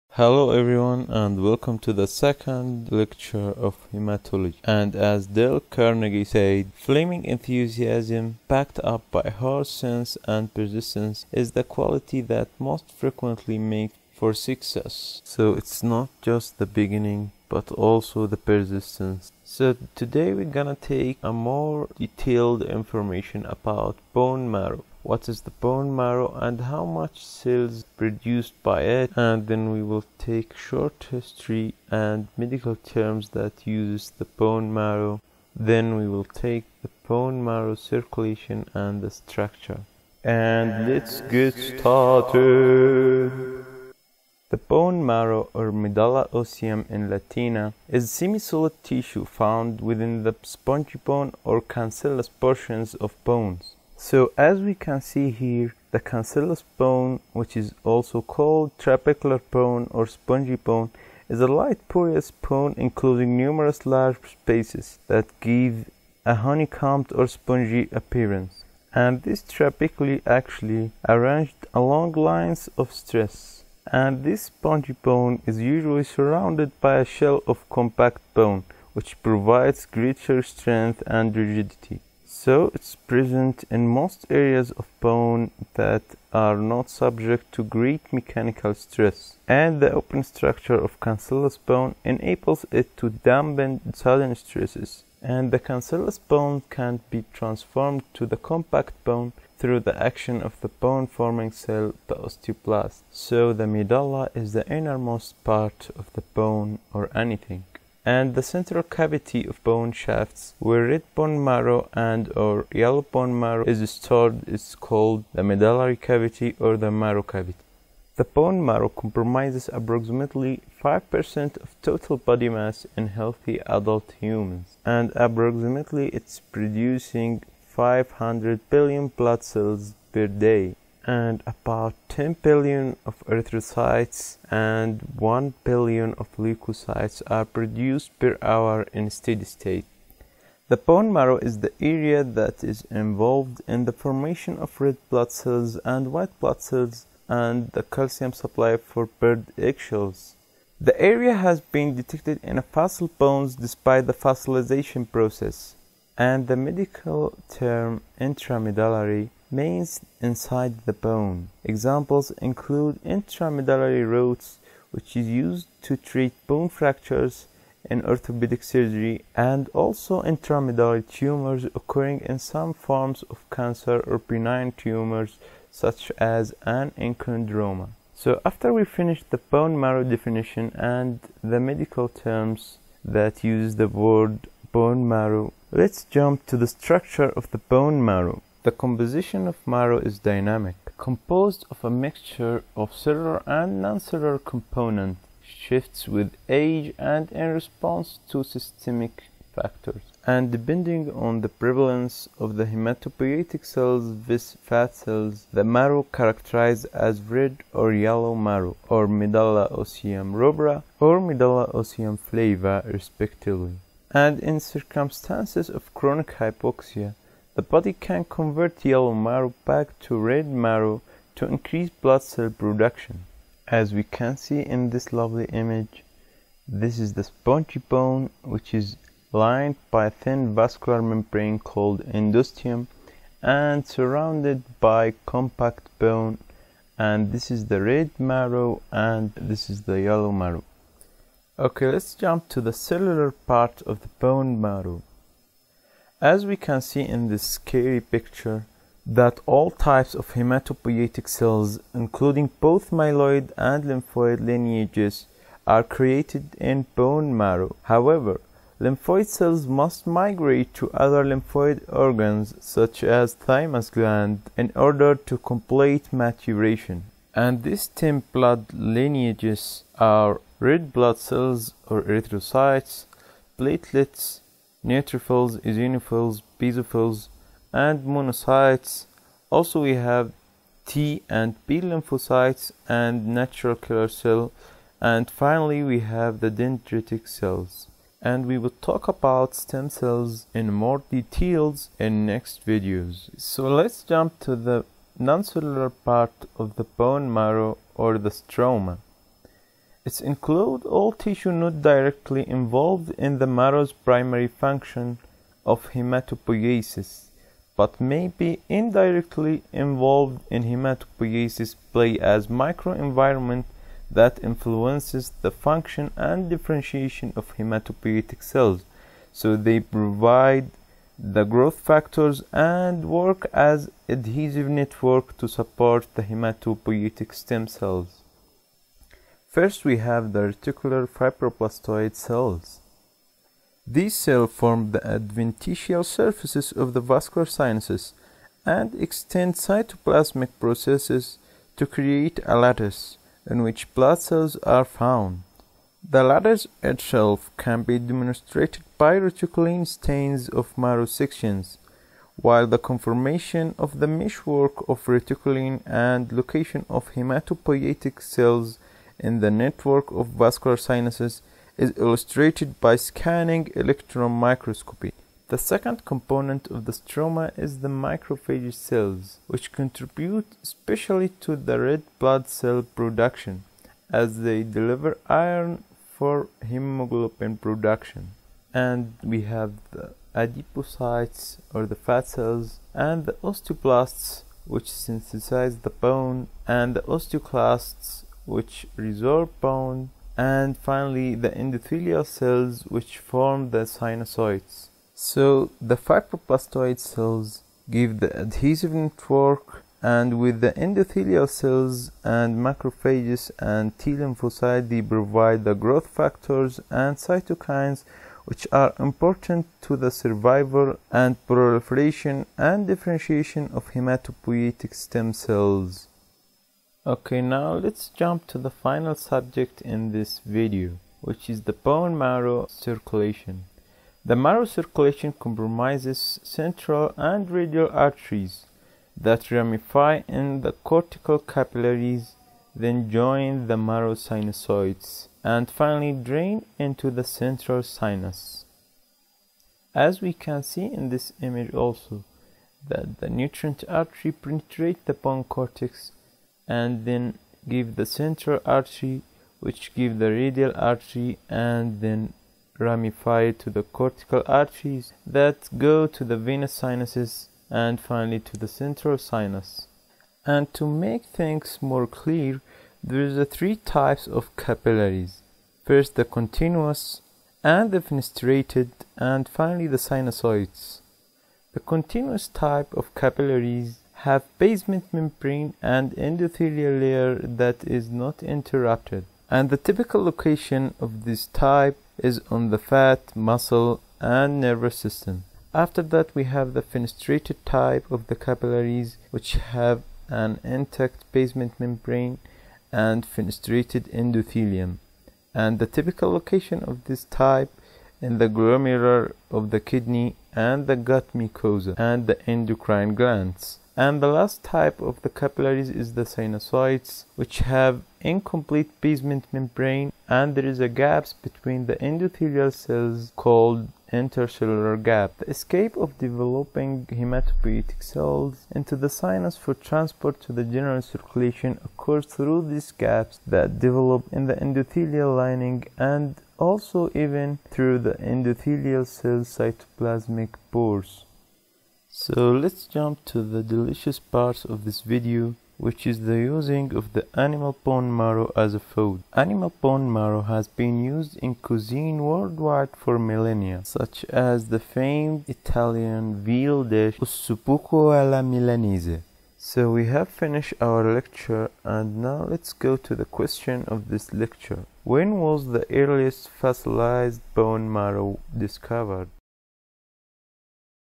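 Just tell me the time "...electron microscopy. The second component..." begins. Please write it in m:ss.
6:03.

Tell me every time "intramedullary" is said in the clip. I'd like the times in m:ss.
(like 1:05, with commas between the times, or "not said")
2:38, 2:43, 2:50.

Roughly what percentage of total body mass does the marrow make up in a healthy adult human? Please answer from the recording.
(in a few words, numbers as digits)
5%.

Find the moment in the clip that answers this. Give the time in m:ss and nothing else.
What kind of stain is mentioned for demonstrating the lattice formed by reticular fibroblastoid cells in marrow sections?
5:49.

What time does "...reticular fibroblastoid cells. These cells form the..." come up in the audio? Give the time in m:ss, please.
5:30.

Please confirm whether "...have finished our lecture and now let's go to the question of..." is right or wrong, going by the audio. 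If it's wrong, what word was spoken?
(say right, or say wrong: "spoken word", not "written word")
right.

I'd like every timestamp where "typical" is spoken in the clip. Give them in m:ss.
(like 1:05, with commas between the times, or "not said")
7:59, 8:15.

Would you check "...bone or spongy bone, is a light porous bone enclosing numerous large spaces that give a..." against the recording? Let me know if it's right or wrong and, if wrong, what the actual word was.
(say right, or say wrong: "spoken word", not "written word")
right.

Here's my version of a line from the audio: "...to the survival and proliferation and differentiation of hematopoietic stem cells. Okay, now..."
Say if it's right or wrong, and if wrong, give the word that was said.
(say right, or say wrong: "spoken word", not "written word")
right.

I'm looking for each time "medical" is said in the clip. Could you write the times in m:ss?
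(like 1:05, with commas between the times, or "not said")
0:32, 2:36, 3:01.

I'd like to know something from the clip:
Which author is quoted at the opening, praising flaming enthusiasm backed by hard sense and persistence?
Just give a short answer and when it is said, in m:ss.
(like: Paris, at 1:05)
Dale Carnegie, at 0:05.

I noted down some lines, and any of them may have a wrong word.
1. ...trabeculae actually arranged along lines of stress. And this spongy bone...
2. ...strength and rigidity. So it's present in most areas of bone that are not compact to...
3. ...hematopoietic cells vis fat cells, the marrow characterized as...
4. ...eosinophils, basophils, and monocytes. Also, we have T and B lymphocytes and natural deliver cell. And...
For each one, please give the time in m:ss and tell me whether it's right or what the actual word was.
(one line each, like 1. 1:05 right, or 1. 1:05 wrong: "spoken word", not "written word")
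1. 1:09 right
2. 1:20 wrong: "subject", not "compact"
3. 3:22 right
4. 4:35 wrong: "killer", not "deliver".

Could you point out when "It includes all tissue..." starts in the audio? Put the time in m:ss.
5:00.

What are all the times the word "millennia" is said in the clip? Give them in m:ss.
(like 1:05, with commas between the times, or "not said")
9:03.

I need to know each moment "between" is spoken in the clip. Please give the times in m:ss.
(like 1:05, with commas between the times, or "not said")
8:31.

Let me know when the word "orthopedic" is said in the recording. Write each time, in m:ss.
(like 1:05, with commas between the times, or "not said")
2:48.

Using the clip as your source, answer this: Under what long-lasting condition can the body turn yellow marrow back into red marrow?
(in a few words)
chronic hypoxia.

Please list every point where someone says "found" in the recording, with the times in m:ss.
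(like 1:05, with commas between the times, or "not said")
0:49, 5:44.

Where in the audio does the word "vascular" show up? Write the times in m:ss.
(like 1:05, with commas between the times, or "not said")
3:50, 5:37, 6:00.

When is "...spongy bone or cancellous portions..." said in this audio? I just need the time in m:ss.
0:50.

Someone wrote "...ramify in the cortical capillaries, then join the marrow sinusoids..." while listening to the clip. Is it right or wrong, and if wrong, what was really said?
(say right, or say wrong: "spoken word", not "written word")
right.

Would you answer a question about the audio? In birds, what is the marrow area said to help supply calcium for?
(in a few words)
eggshells.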